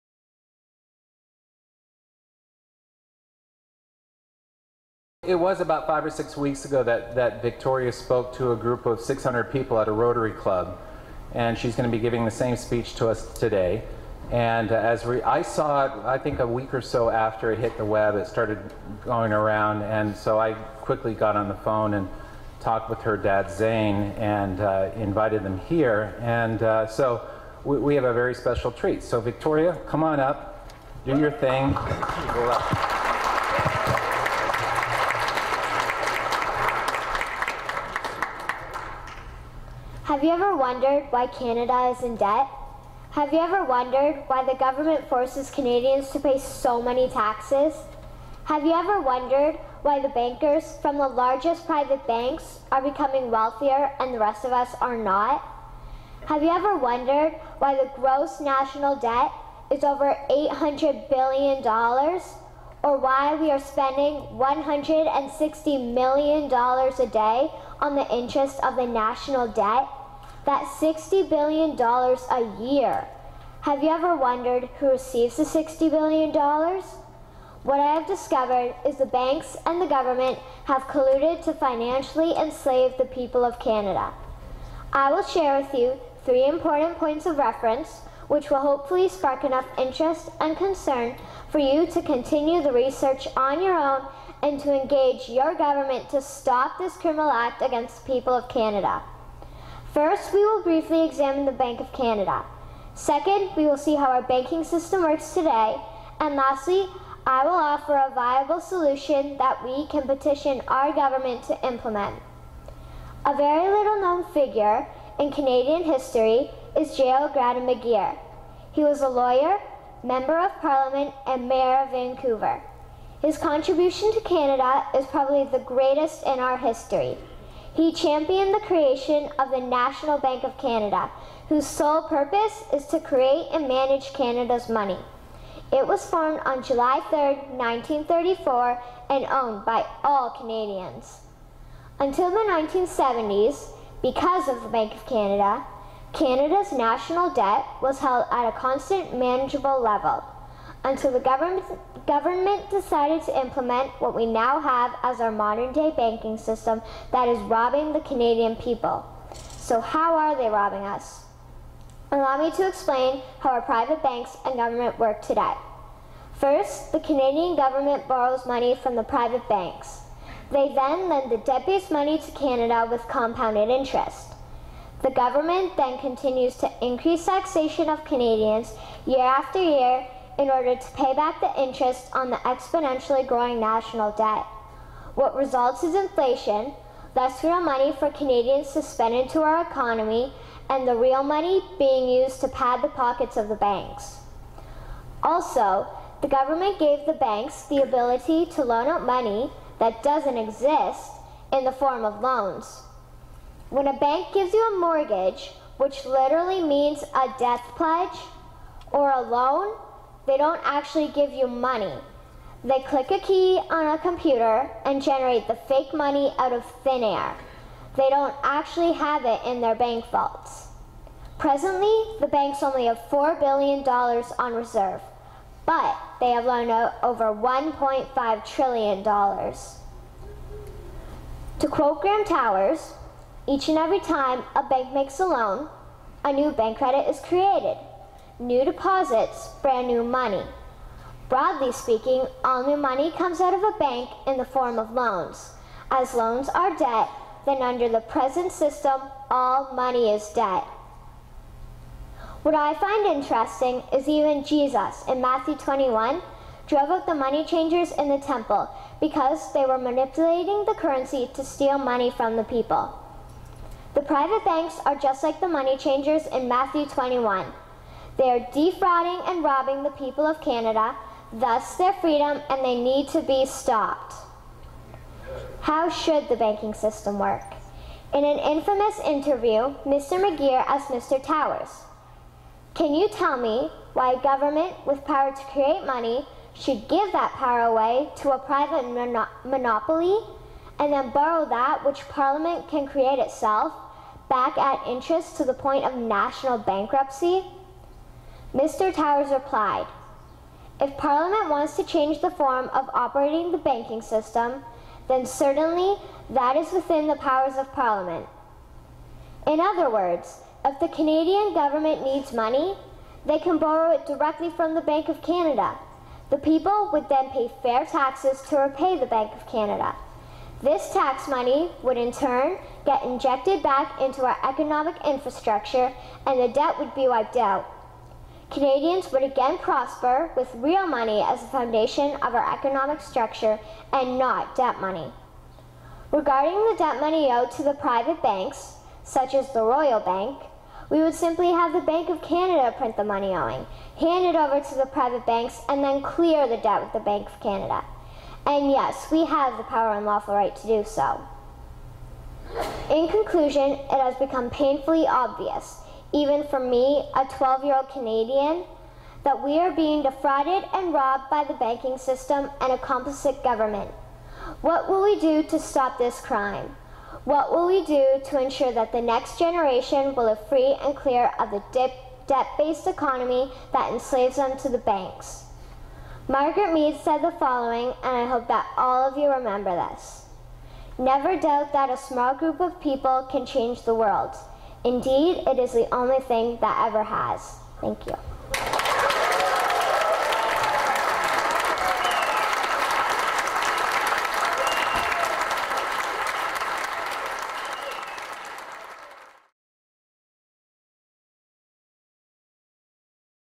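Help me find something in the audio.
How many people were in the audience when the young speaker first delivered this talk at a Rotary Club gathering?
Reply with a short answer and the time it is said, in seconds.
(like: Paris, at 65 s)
600, at 8 s.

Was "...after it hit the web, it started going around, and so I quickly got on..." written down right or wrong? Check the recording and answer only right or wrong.
right.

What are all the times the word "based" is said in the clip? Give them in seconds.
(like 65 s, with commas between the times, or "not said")
171 s, 372 s.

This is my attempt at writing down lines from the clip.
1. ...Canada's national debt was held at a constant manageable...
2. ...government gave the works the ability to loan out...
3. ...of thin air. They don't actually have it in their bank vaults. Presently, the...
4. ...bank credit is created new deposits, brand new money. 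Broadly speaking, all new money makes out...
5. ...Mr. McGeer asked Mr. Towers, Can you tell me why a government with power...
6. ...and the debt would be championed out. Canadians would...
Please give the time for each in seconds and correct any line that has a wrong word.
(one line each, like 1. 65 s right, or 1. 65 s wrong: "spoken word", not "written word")
1. 146 s right
2. 196 s wrong: "banks", not "works"
3. 216 s right
4. 236 s wrong: "comes", not "makes"
5. 279 s right
6. 326 s wrong: "wiped", not "championed".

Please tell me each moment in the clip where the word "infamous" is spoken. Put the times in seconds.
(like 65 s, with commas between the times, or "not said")
278 s.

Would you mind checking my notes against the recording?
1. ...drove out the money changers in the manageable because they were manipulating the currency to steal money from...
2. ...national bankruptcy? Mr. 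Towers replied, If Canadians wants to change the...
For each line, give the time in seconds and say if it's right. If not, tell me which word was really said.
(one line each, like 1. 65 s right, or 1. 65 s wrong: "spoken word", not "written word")
1. 256 s wrong: "temple", not "manageable"
2. 295 s wrong: "Parliament", not "Canadians".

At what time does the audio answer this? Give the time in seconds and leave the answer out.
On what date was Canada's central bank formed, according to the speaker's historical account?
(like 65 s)
136 s.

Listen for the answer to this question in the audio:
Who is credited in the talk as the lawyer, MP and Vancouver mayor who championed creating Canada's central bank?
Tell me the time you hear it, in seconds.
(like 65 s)
116 s.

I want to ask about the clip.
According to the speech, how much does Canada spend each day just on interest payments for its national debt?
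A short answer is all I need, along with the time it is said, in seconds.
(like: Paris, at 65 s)
$160 million, at 64 s.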